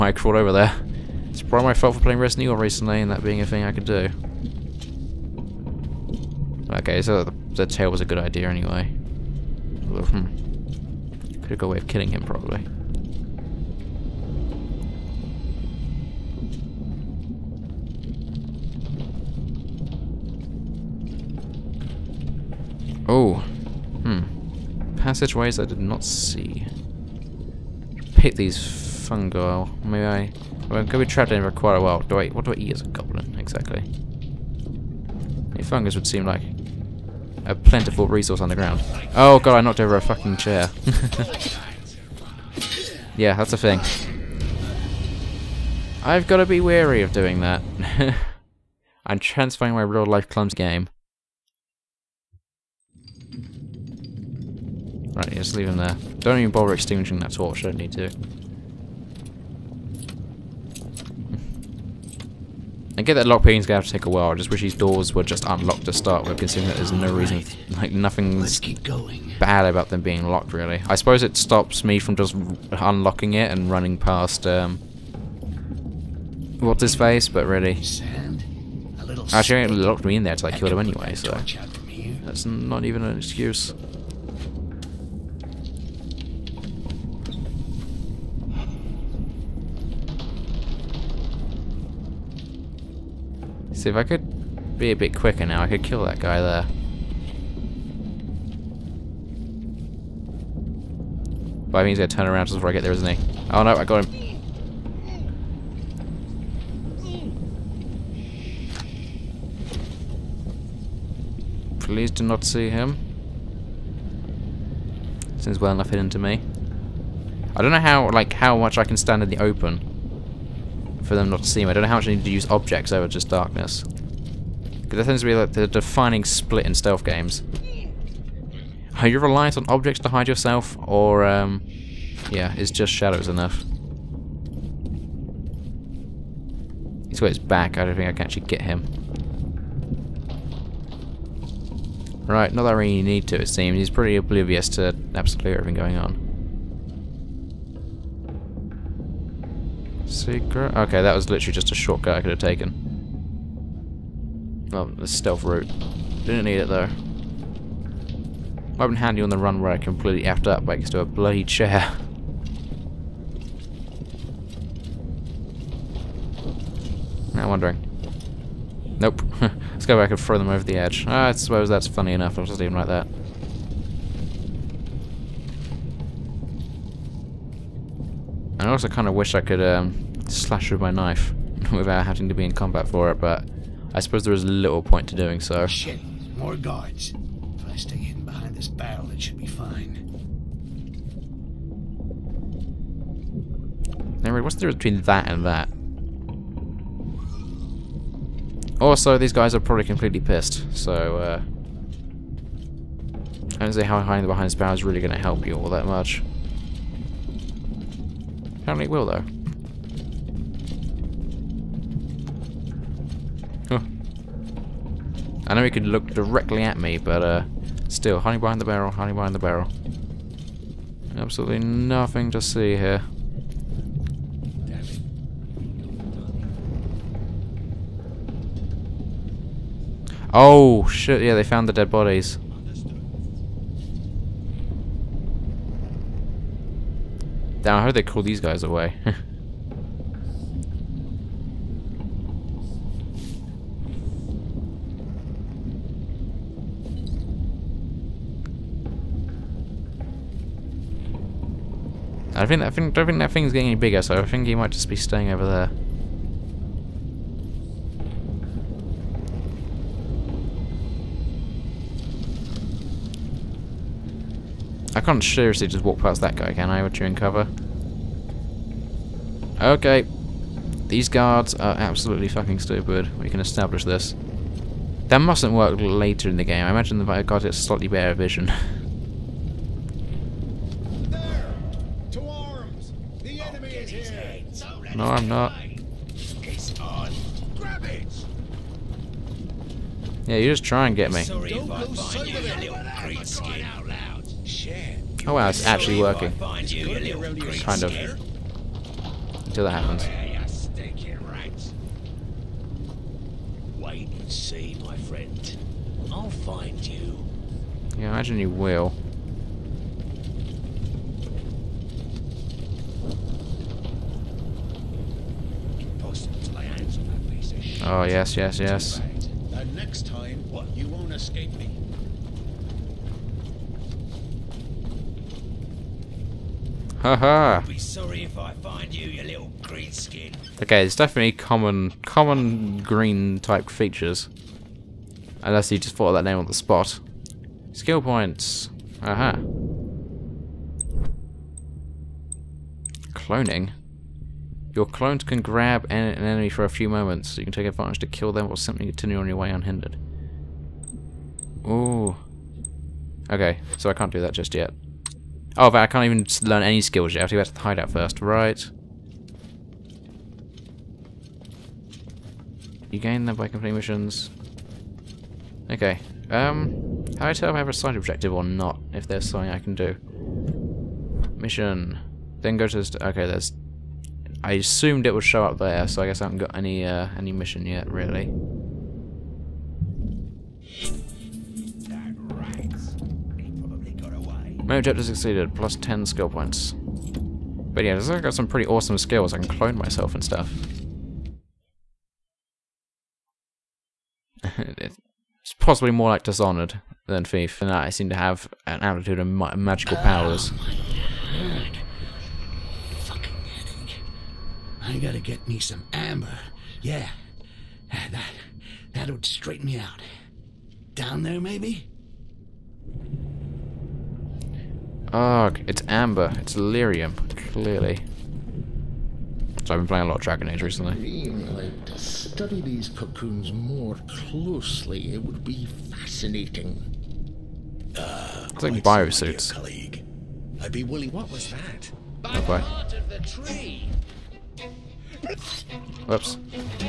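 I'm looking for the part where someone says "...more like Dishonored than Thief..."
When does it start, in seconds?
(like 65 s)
395 s.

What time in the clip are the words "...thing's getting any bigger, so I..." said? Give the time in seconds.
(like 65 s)
253 s.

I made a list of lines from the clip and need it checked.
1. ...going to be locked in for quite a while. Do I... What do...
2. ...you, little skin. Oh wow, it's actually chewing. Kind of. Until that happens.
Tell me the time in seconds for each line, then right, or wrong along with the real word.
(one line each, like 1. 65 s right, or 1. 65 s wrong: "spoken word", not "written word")
1. 30 s wrong: "trapped", not "locked"
2. 292 s wrong: "working", not "chewing".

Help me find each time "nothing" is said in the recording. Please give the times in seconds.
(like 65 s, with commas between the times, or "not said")
67 s, 221 s.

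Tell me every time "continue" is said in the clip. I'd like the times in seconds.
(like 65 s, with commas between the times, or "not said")
348 s.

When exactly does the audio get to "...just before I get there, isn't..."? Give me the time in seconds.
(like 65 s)
102 s.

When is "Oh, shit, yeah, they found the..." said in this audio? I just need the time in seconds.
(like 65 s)
230 s.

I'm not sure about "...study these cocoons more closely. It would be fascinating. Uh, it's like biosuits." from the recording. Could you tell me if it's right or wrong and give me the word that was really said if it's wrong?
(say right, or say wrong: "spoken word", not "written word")
right.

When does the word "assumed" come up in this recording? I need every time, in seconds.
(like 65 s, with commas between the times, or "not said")
374 s.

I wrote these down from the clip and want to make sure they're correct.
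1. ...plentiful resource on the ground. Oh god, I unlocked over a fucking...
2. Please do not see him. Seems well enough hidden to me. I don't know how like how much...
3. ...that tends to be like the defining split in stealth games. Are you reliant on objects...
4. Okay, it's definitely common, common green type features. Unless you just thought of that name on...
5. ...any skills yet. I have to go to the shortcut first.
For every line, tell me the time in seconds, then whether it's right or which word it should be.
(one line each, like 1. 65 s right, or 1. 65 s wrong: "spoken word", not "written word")
1. 37 s wrong: "knocked", not "unlocked"
2. 111 s right
3. 124 s right
4. 330 s right
5. 356 s wrong: "hideout", not "shortcut".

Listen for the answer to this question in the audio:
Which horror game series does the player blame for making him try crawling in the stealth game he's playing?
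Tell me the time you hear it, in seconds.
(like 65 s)
2 s.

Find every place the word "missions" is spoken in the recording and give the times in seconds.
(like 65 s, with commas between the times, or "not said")
363 s, 371 s, 377 s.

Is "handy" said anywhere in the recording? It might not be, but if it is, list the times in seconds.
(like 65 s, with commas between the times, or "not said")
158 s.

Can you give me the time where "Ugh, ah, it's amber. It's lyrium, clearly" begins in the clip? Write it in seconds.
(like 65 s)
415 s.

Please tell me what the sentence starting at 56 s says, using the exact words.
Don't even bother extinguishing that torch, I don't need to.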